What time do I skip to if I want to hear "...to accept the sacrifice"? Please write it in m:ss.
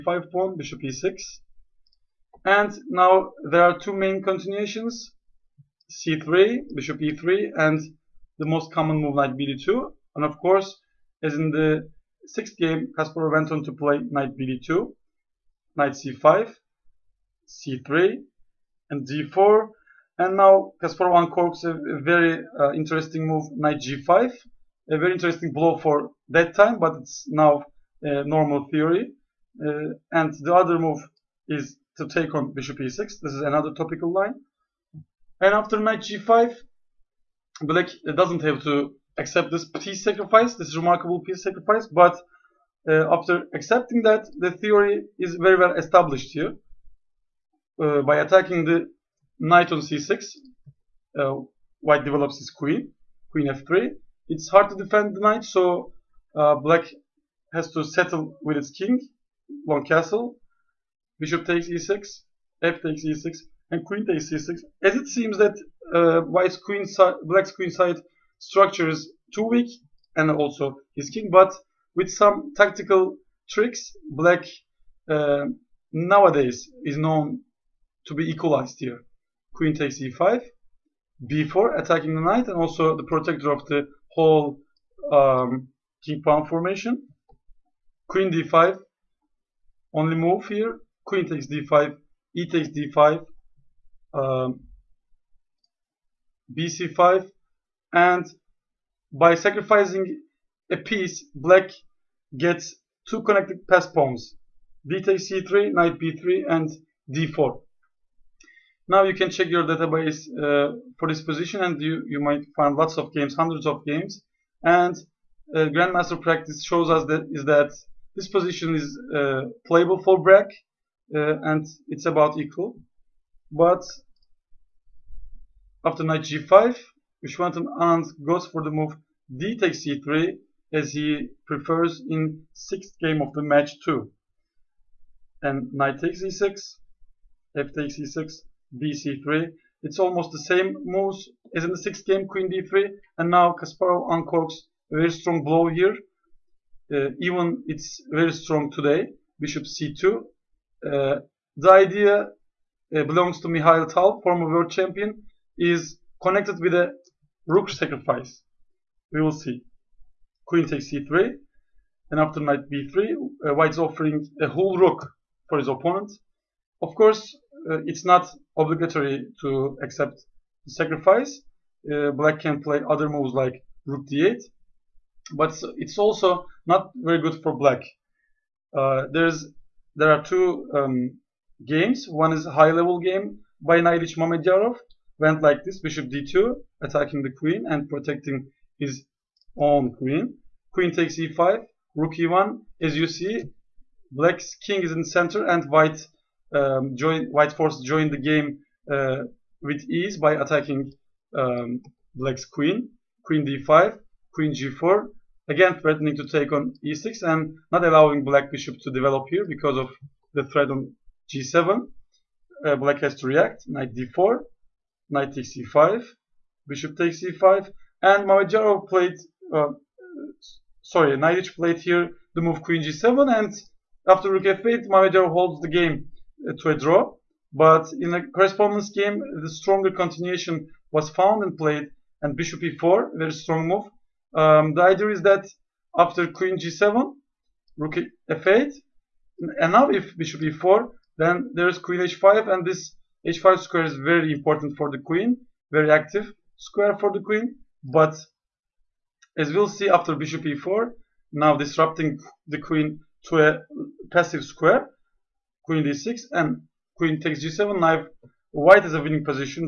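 2:49.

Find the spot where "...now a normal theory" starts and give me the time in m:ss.
0:27.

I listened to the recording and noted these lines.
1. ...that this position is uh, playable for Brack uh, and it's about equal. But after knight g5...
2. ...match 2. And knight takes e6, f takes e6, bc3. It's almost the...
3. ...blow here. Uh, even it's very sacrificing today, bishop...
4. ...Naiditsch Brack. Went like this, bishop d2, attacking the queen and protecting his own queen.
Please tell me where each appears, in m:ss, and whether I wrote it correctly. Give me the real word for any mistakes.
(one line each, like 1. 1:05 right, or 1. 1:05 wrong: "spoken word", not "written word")
1. 1:57 right
2. 2:13 right
3. 2:25 wrong: "strong", not "sacrificing"
4. 3:03 wrong: "Mamedyarov", not "Brack".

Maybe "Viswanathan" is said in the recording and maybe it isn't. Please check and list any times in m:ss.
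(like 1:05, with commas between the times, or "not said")
2:07.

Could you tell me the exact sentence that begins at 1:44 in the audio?
b takes c3, knight b3 and d4.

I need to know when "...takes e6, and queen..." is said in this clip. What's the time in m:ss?
1:02.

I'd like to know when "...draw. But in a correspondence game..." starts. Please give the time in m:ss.
3:46.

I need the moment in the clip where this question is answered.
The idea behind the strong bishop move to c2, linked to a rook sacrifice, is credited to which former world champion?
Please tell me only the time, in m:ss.
2:33.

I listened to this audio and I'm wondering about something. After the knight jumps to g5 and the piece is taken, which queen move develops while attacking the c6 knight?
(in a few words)
Queen f3.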